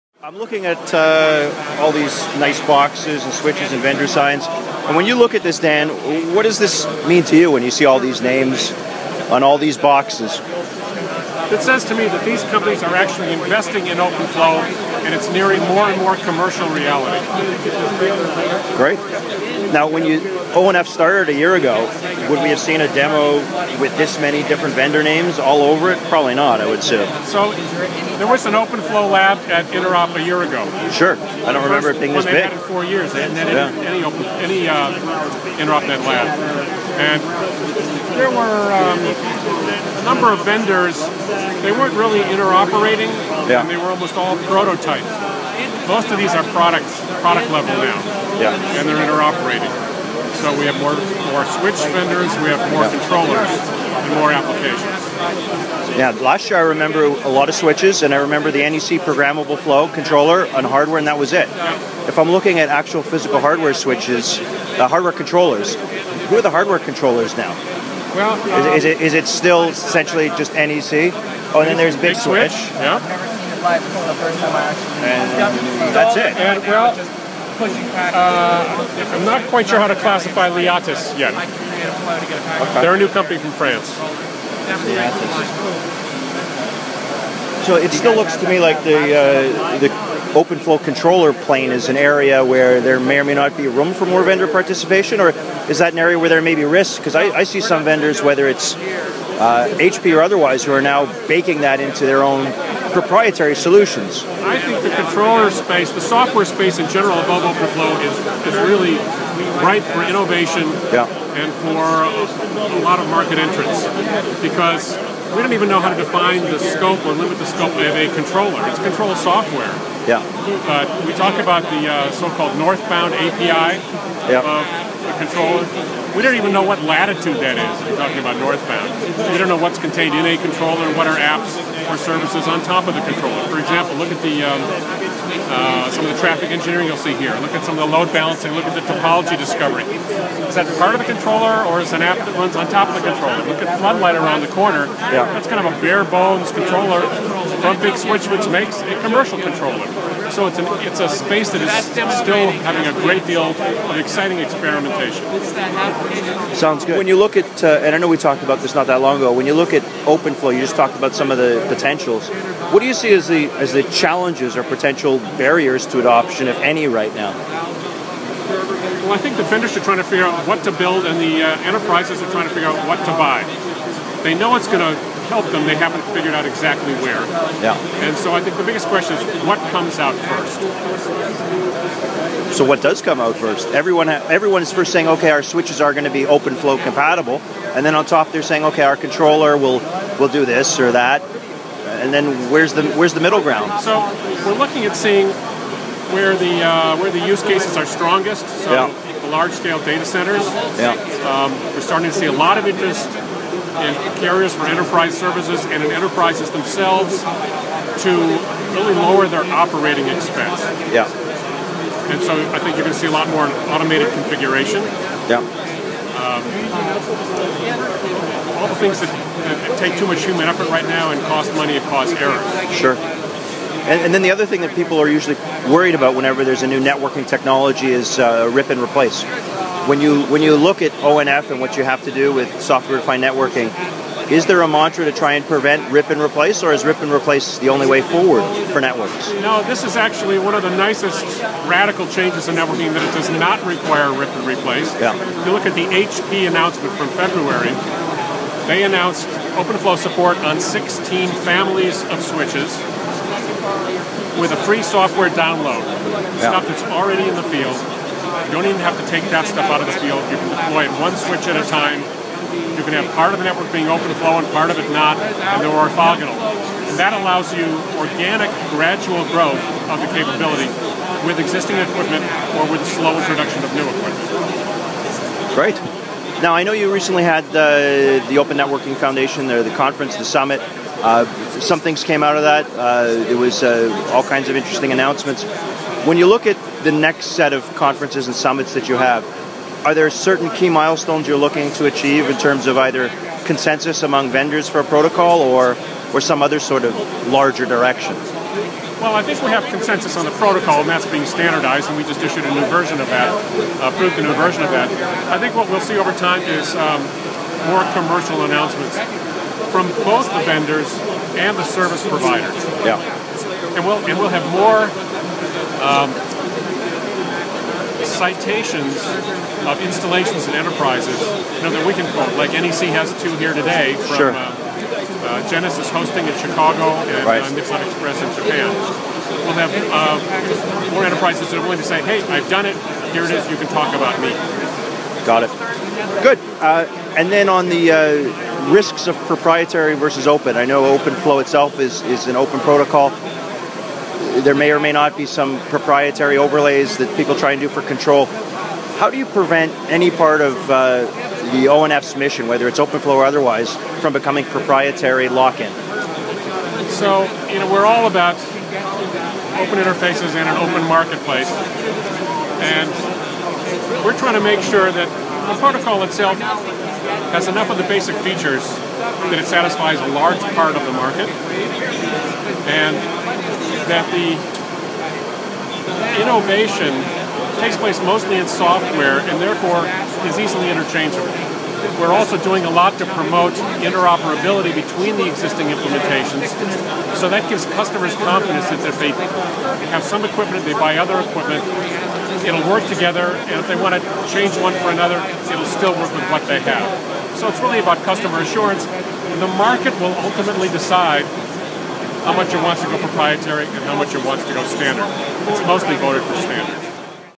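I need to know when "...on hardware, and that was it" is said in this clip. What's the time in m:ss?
1:00.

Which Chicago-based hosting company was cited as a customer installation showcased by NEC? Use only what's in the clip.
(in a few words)
Genesis hosting.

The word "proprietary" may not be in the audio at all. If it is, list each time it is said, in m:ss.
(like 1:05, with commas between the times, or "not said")
1:42, 5:39, 5:45, 5:54, 6:42.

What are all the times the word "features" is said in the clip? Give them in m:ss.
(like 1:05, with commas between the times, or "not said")
6:08.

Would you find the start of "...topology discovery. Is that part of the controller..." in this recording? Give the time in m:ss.
2:18.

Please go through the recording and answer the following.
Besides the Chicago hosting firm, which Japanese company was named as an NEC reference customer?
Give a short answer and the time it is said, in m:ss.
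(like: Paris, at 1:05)
Nippon Express, at 5:27.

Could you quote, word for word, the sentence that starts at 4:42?
Uh, there was uh, all kinds of interesting announcements.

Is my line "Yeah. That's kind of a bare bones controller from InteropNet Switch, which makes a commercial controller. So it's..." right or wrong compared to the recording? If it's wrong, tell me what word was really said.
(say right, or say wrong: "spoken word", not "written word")
wrong: "Big", not "InteropNet".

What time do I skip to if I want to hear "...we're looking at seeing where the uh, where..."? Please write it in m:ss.
3:14.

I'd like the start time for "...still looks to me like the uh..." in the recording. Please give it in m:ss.
1:27.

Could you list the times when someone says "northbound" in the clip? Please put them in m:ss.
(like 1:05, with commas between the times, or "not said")
2:02, 2:08.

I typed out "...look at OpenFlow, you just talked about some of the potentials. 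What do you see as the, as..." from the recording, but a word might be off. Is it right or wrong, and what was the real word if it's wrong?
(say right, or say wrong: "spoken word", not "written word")
right.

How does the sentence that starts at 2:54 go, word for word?
They know it's going to help them, they haven't figured out exactly where.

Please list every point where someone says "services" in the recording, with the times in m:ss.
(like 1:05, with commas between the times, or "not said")
2:11, 3:25, 5:11.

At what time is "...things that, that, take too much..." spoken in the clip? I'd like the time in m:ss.
3:38.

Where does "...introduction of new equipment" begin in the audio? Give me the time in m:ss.
4:33.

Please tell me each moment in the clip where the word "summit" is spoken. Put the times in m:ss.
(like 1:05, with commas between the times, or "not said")
4:40, 4:48.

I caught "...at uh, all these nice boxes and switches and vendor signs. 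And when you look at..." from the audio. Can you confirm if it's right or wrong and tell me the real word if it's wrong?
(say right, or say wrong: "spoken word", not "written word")
right.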